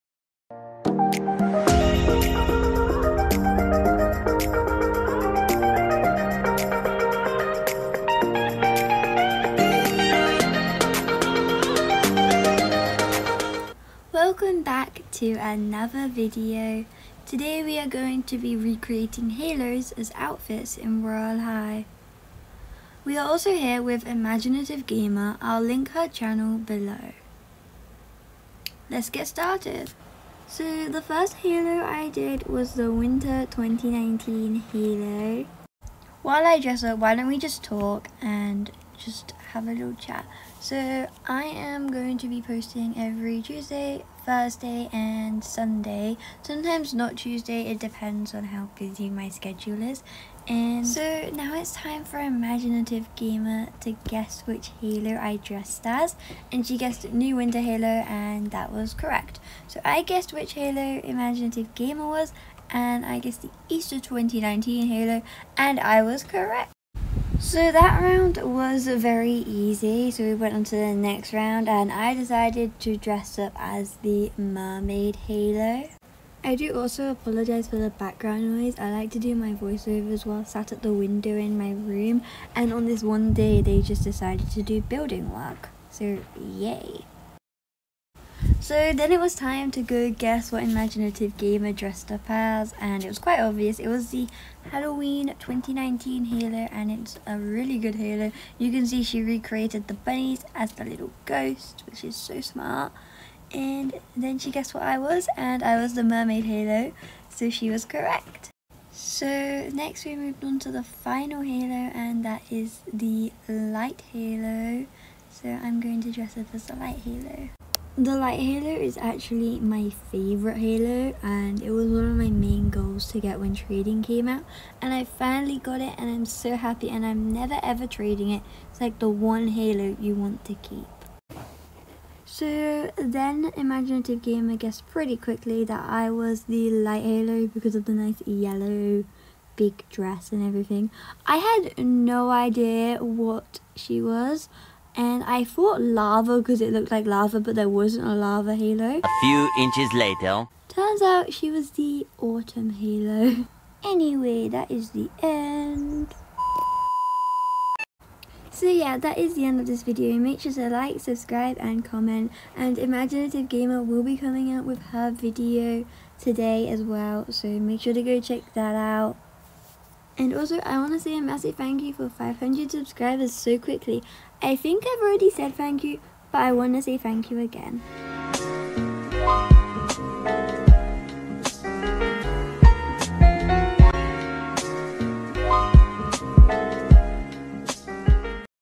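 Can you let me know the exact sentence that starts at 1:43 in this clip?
And then she guessed what I was and I was the mermaid Halo so she was correct.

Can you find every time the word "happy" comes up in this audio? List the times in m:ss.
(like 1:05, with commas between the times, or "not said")
2:06.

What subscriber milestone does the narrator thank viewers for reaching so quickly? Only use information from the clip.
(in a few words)
500.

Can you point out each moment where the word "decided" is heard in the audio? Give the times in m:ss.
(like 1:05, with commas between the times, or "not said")
1:12, 1:24.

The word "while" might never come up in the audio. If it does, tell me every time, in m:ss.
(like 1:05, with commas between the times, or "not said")
0:36, 1:20.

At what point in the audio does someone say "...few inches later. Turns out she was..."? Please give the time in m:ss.
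2:29.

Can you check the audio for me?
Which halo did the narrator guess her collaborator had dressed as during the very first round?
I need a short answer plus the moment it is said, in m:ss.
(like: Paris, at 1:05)
Easter 2019 halo, at 1:03.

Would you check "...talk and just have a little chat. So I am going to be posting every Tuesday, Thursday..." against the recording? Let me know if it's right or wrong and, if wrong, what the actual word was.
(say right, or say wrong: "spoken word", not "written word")
right.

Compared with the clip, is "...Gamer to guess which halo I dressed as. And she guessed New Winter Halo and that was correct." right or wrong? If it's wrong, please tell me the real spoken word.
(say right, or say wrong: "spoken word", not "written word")
right.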